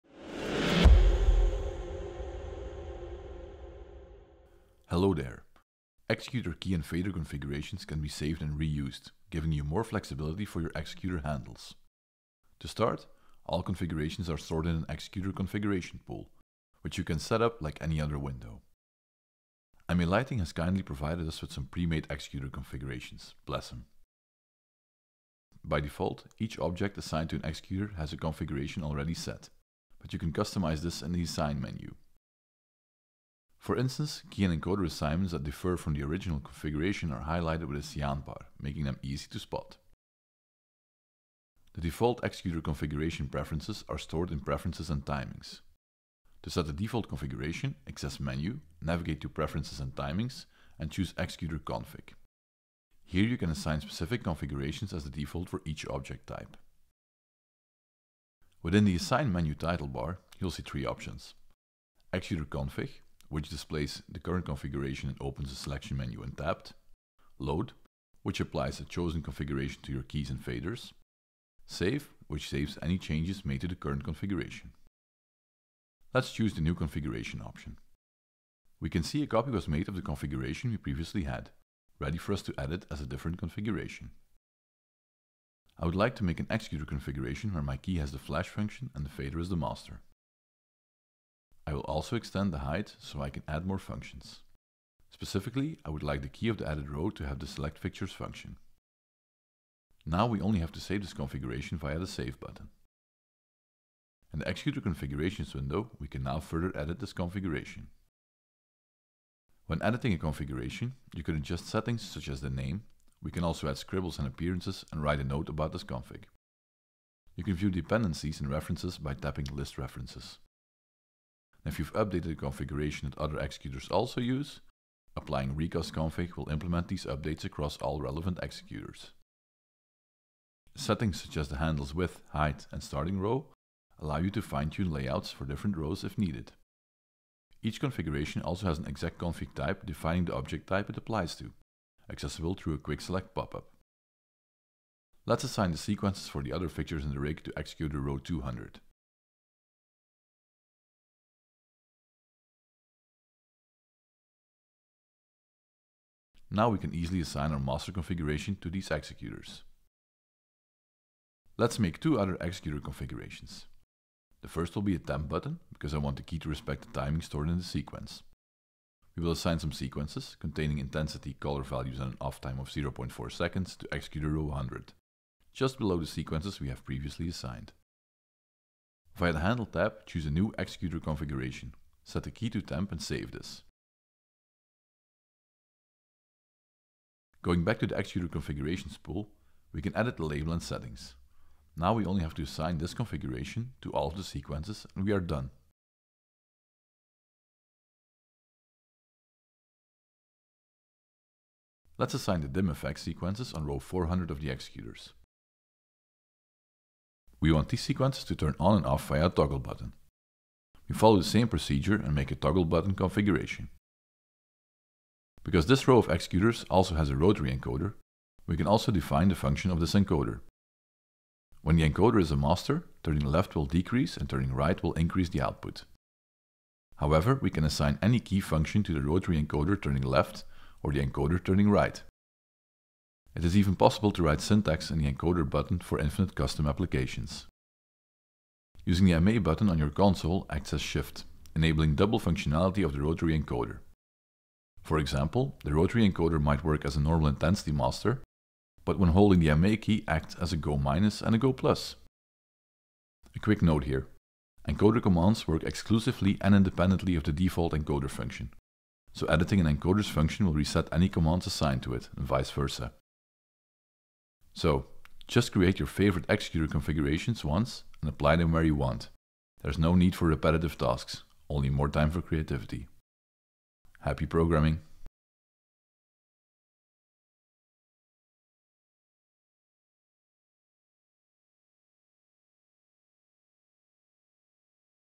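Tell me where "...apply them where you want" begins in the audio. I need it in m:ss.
4:28.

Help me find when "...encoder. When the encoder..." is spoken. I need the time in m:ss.
3:39.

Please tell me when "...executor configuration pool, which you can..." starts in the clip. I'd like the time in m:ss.
0:14.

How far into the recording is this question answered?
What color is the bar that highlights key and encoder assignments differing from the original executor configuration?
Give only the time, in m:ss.
0:37.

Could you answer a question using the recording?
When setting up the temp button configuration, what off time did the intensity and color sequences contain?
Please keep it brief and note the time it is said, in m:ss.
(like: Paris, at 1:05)
0.4 seconds, at 2:52.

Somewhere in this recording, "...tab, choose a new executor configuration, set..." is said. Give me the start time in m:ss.
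2:59.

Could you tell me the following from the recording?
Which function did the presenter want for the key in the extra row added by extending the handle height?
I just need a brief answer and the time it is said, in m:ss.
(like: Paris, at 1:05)
Select fixtures, at 1:37.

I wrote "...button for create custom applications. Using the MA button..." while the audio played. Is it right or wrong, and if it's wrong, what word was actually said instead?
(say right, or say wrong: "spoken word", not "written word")
wrong: "infinite", not "create".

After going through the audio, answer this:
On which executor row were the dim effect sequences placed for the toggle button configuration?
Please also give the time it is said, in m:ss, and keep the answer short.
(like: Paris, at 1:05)
400, at 3:23.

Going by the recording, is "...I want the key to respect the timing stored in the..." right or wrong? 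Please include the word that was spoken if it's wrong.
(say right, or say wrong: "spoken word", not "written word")
right.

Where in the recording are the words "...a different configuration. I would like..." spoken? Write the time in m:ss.
1:22.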